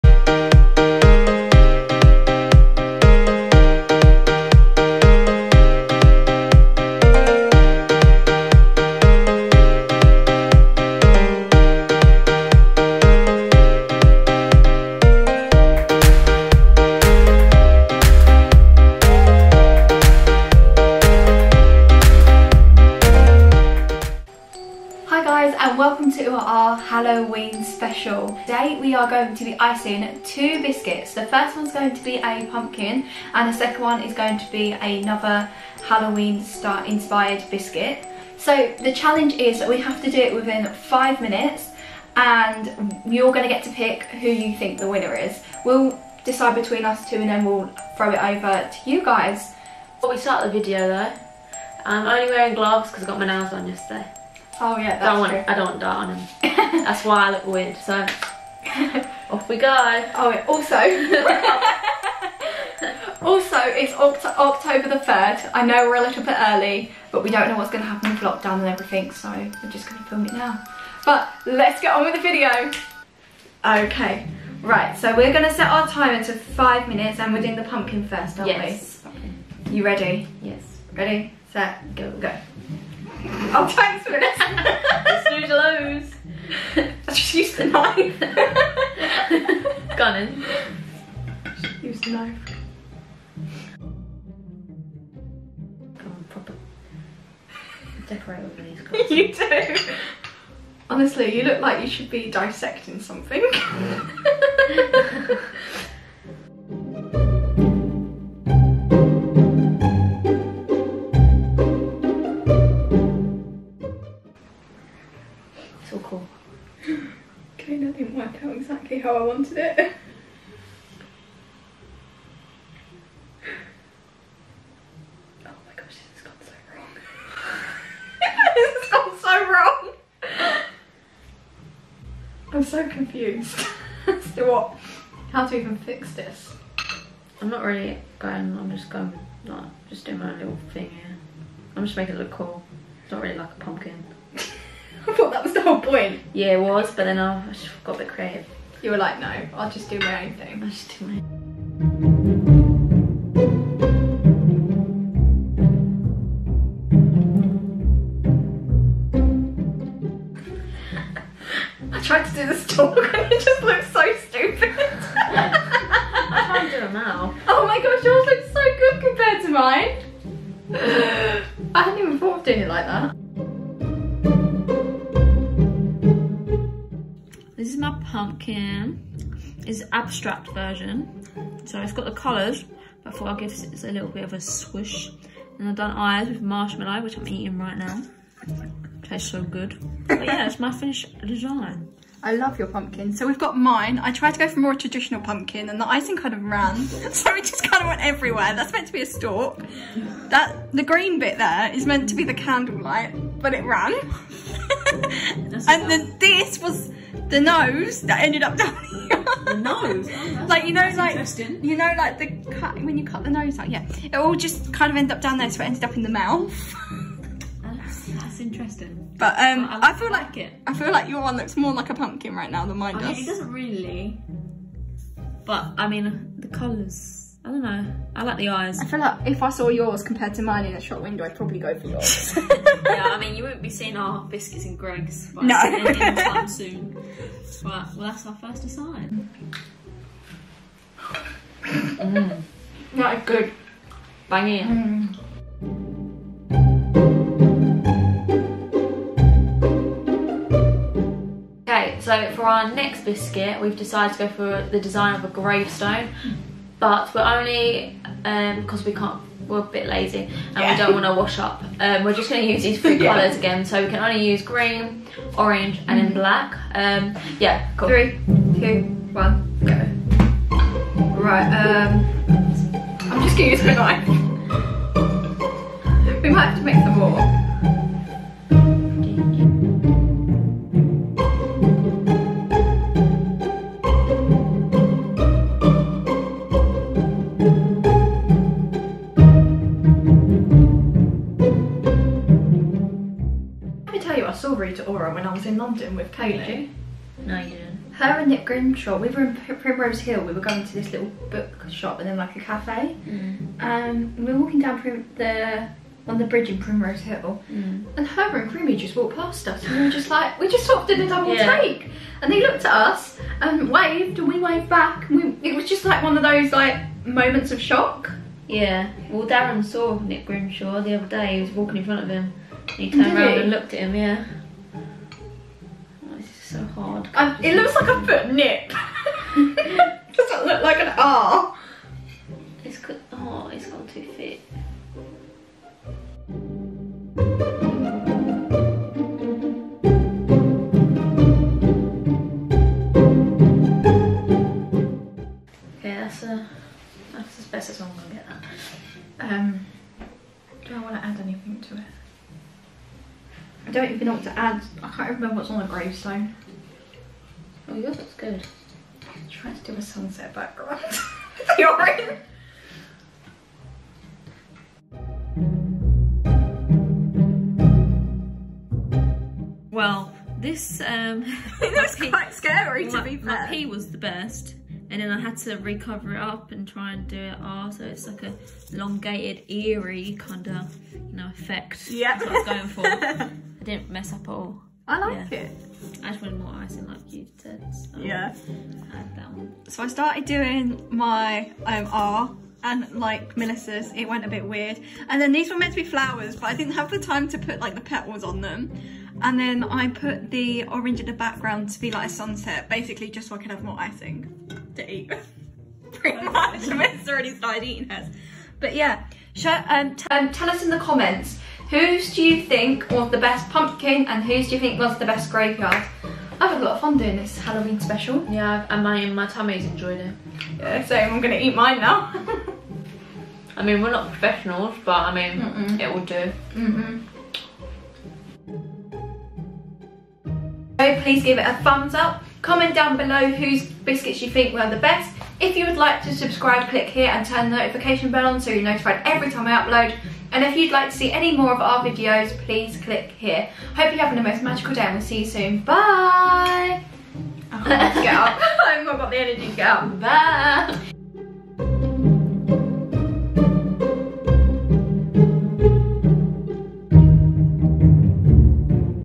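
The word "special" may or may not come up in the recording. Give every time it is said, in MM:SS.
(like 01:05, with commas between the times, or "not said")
00:27, 06:57.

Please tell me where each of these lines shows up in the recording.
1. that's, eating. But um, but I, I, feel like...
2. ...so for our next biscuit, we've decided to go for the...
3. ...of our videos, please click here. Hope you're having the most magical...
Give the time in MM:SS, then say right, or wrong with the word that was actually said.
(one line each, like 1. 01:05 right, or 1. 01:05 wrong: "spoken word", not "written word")
1. 03:37 wrong: "interesting", not "eating"
2. 04:12 right
3. 07:21 right.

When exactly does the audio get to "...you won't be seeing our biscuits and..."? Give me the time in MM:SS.
03:53.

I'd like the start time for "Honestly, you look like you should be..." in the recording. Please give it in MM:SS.
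01:40.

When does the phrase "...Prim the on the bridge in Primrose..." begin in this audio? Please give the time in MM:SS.
05:04.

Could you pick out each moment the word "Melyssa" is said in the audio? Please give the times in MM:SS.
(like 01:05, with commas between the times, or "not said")
06:33, 06:46.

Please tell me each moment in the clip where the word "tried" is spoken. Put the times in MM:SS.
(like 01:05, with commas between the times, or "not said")
02:42, 03:14.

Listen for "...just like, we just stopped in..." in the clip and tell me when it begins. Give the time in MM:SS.
05:09.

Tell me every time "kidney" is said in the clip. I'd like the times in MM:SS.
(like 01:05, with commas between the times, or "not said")
not said.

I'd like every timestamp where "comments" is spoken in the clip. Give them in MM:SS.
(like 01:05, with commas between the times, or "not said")
06:50, 07:12.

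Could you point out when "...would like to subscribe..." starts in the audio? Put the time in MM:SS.
07:15.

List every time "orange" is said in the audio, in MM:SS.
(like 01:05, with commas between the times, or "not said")
04:25, 06:40.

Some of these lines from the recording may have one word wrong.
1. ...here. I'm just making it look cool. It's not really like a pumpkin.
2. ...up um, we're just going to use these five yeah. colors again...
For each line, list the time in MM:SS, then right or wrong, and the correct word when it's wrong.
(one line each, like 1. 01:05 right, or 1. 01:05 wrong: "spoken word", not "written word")
1. 02:20 right
2. 04:21 wrong: "three", not "five".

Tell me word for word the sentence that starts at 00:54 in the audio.
Oh yeah, that's don't want, true.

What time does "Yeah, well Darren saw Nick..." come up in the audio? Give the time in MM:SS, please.
05:18.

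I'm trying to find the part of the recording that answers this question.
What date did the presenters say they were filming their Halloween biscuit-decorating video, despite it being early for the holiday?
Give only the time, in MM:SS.
01:04.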